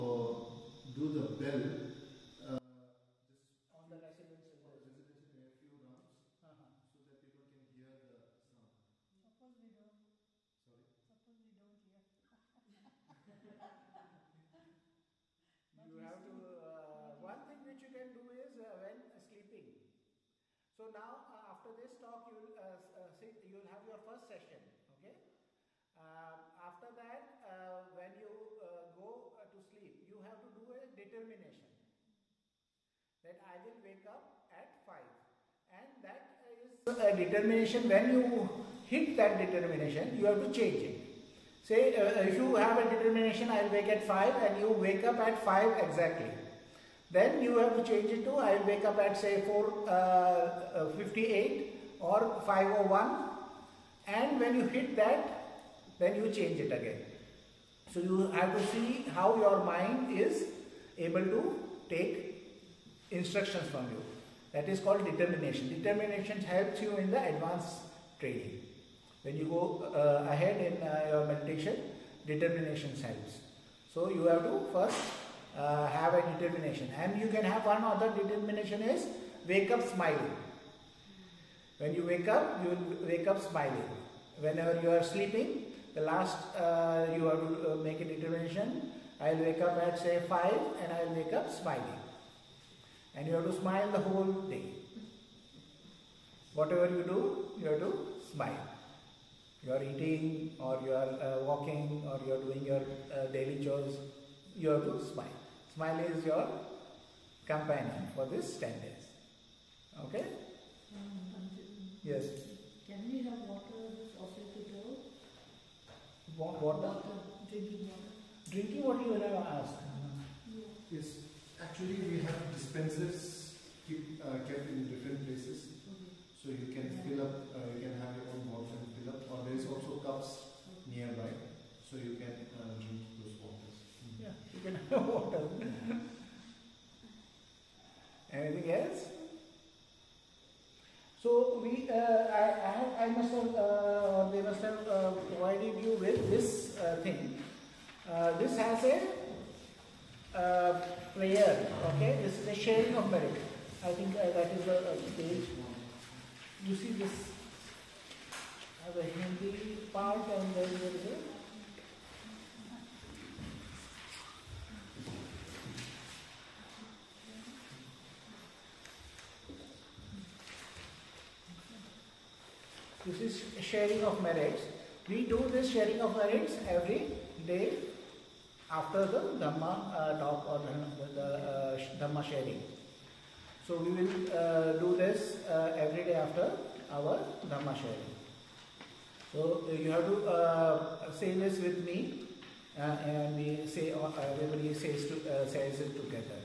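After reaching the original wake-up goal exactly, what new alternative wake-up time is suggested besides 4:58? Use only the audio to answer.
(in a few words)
5:01.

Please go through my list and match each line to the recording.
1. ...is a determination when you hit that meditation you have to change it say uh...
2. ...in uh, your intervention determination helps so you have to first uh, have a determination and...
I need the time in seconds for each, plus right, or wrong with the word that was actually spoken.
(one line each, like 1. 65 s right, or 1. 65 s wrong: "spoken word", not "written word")
1. 36 s wrong: "determination", not "meditation"
2. 70 s wrong: "meditation", not "intervention".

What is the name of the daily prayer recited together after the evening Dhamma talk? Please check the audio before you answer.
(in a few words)
sharing of merit.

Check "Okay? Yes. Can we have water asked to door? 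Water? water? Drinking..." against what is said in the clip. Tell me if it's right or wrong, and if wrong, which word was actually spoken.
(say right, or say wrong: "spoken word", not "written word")
wrong: "offered", not "asked".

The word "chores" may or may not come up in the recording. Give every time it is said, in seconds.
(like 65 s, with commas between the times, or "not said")
103 s.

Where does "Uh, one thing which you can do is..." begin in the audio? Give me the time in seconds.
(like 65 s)
16 s.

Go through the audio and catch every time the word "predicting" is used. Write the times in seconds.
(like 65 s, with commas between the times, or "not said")
not said.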